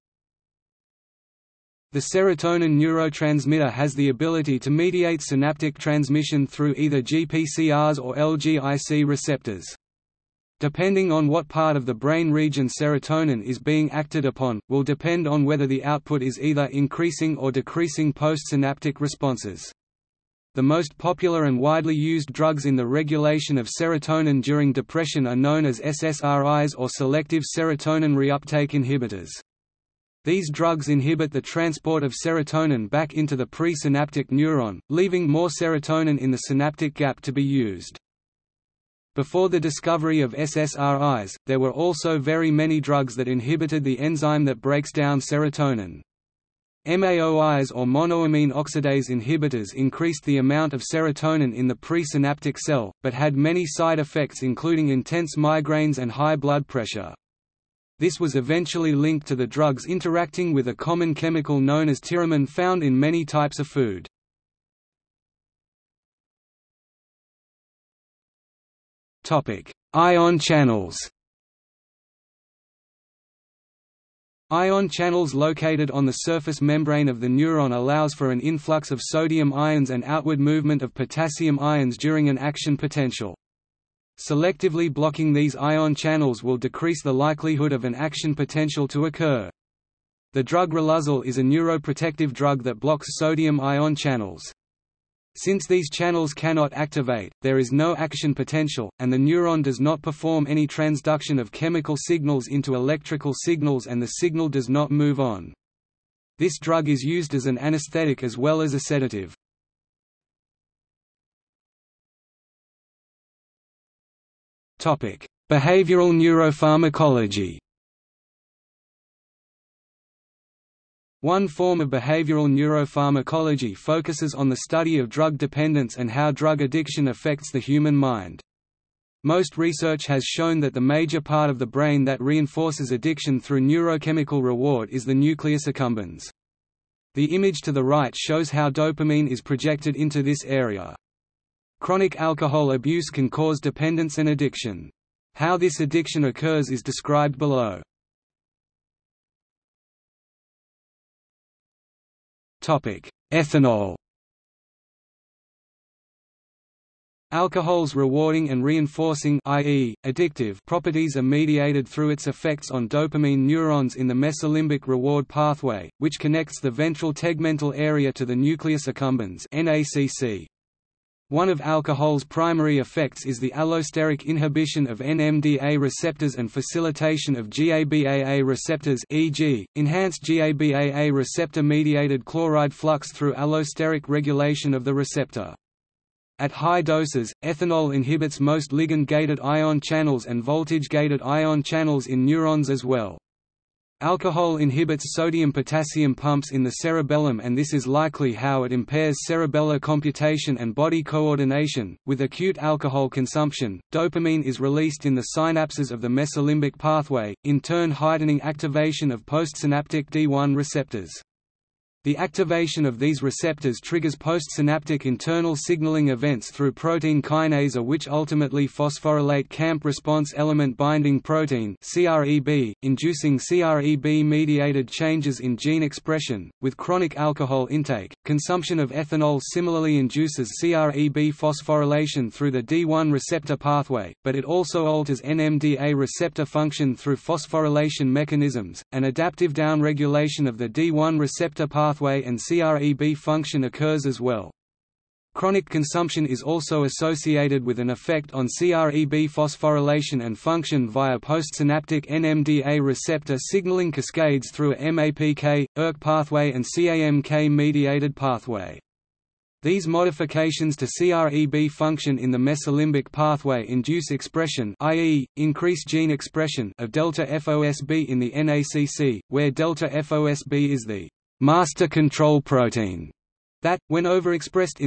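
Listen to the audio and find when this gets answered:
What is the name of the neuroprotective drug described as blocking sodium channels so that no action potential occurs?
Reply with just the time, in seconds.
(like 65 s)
90 s.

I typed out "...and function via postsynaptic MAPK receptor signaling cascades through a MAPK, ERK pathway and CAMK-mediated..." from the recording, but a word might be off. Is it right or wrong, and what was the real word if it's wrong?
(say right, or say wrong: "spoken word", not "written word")
wrong: "NMDA", not "MAPK".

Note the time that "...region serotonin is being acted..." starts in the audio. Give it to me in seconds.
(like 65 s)
12 s.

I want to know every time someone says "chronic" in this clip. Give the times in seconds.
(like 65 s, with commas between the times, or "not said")
141 s, 226 s, 245 s.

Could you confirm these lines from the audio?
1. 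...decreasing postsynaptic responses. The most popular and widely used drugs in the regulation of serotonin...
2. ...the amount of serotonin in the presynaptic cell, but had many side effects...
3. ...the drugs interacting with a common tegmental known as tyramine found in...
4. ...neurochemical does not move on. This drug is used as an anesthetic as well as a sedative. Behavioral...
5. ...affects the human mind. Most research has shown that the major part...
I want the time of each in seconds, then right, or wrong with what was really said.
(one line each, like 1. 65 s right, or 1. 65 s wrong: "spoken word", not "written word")
1. 17 s right
2. 50 s right
3. 59 s wrong: "chemical", not "tegmental"
4. 104 s wrong: "signal", not "neurochemical"
5. 127 s right.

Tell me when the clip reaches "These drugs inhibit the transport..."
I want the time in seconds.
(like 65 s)
30 s.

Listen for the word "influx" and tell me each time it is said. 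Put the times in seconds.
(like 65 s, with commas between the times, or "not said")
78 s.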